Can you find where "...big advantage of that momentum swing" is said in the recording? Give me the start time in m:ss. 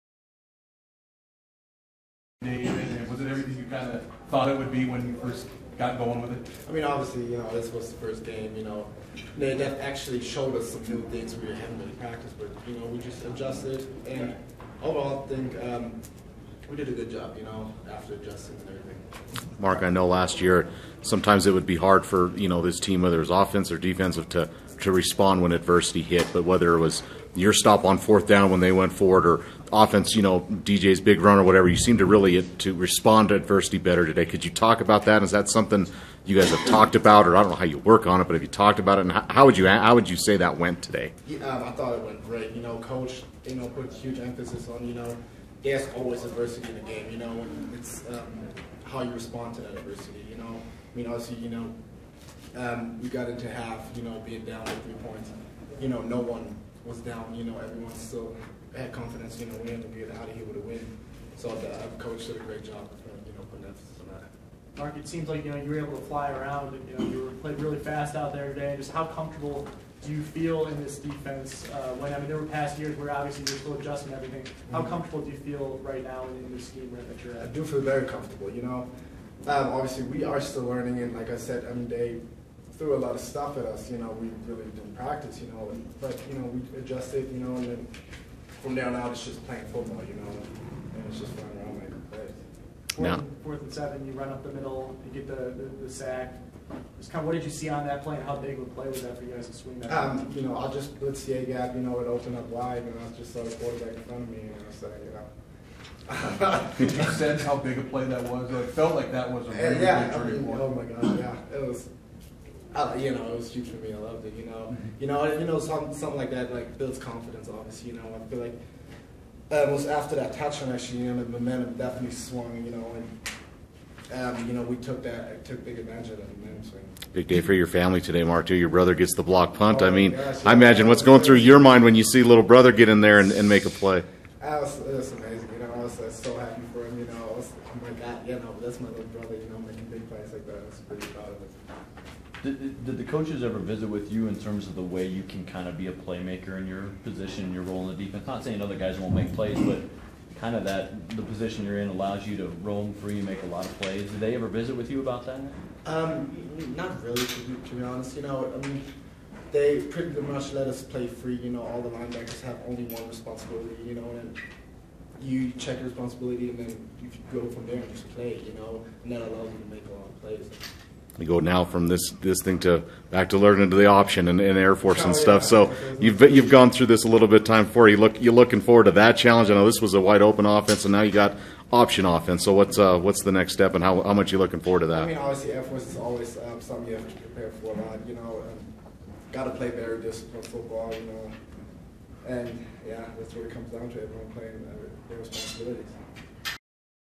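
2:05.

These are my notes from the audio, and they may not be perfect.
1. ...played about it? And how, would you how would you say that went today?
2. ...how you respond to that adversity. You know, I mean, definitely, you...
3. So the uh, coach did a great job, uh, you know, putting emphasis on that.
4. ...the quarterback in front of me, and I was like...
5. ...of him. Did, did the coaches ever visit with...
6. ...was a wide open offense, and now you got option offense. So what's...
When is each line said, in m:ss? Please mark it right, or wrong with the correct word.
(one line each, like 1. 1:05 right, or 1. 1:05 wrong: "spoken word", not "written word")
1. 0:38 wrong: "talked", not "played"
2. 0:48 wrong: "obviously", not "definitely"
3. 1:01 right
4. 1:43 right
5. 2:21 right
6. 2:59 right.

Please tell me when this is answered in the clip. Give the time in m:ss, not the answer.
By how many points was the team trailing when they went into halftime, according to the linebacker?
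0:54.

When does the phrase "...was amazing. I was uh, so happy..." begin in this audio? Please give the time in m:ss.
2:14.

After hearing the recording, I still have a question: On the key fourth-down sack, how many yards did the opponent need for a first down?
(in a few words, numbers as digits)
7.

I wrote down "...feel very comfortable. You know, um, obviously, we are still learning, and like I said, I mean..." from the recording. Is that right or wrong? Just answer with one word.
right.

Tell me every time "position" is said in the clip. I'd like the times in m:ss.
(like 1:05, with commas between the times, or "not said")
2:27, 2:31.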